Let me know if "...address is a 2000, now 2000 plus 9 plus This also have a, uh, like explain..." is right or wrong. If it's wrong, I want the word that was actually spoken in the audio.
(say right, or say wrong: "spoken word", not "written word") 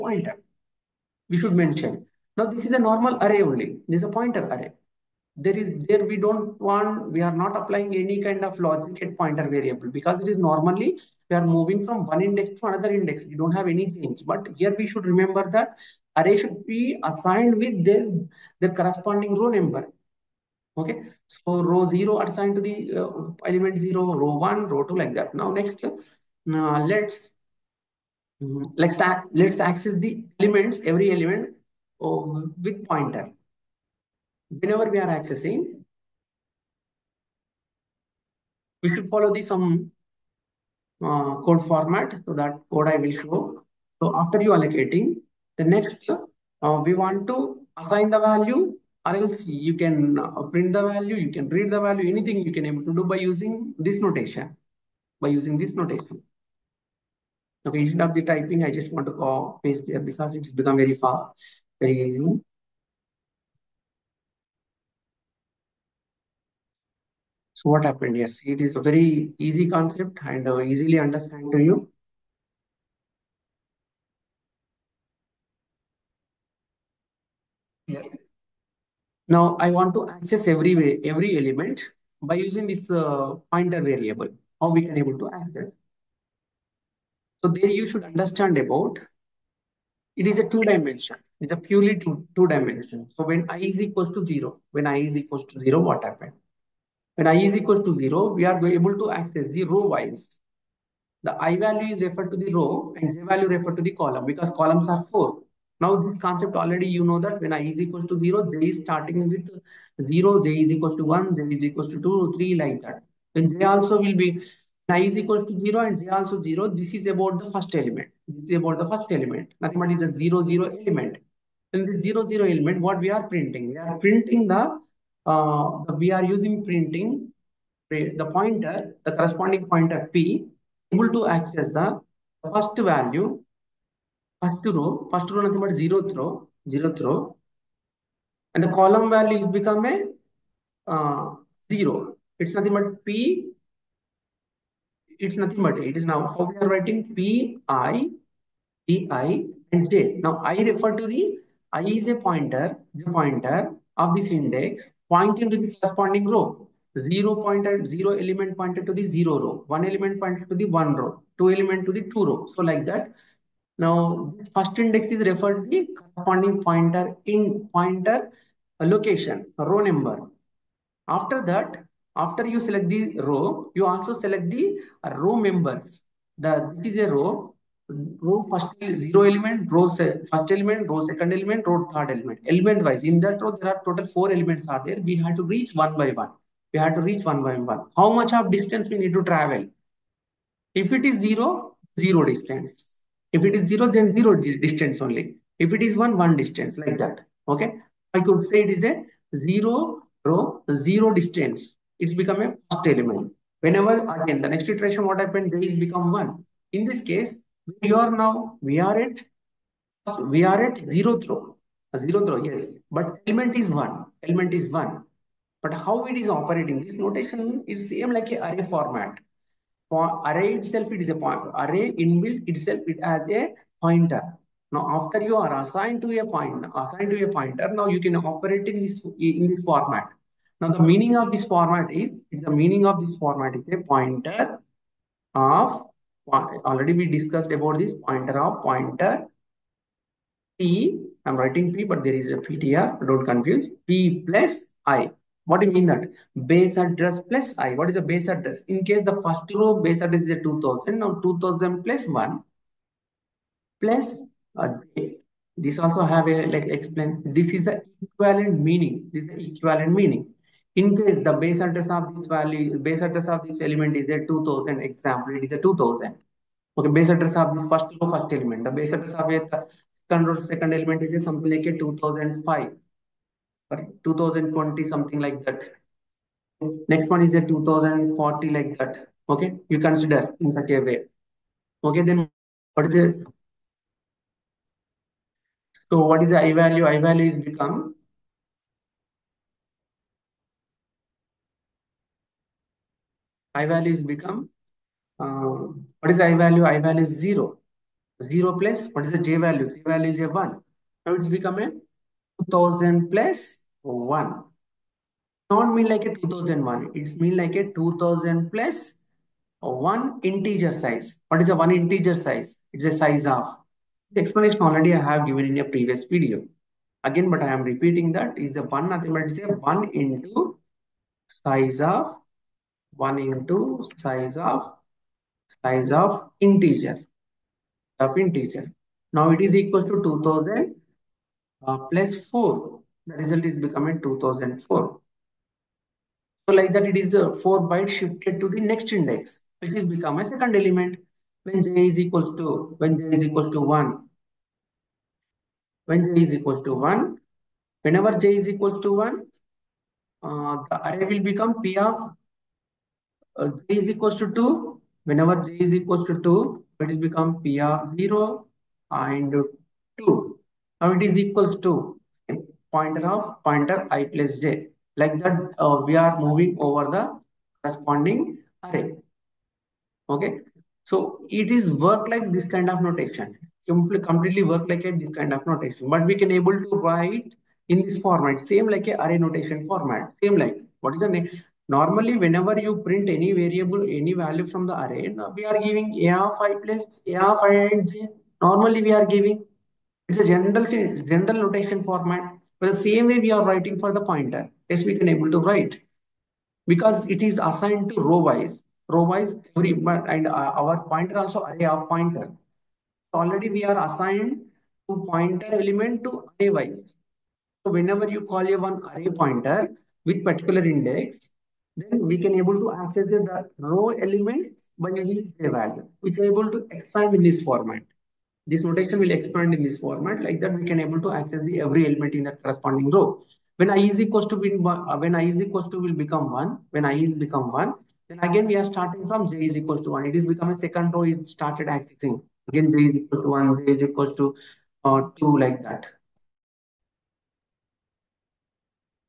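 wrong: "1", not "9".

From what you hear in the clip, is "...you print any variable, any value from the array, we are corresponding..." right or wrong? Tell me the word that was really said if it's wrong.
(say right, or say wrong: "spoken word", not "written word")
wrong: "giving", not "corresponding".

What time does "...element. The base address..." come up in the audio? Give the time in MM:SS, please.
04:28.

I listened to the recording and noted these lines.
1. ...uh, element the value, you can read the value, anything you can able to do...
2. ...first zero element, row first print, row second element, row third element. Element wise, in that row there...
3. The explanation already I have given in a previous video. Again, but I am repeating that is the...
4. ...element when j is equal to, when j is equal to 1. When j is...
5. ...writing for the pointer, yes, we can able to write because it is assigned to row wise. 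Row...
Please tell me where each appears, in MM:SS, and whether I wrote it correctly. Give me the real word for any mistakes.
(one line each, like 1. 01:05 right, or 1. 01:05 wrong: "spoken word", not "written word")
1. 00:50 wrong: "print", not "element"
2. 02:58 wrong: "element", not "print"
3. 05:14 right
4. 05:40 right
5. 06:33 right.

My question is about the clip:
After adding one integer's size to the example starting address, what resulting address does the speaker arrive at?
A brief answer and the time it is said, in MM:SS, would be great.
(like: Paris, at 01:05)
2004, at 05:34.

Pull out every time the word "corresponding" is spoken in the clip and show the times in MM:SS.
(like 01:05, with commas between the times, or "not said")
00:18, 02:09, 02:35, 02:45, 06:07, 07:02.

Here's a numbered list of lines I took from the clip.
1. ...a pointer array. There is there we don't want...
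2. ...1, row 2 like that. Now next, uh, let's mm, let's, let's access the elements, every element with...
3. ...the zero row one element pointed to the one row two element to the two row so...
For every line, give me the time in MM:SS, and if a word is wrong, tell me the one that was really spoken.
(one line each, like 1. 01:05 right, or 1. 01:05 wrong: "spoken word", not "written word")
1. 00:04 right
2. 00:24 right
3. 02:38 right.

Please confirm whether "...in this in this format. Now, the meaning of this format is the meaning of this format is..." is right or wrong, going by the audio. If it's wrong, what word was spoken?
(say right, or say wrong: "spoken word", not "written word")
right.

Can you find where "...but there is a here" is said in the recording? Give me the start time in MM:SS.
04:01.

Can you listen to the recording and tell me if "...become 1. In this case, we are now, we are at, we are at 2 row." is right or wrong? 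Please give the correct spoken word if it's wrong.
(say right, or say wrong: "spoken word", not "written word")
wrong: "0", not "2".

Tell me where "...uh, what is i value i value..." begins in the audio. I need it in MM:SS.
04:55.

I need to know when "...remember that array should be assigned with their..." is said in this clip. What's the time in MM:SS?
00:15.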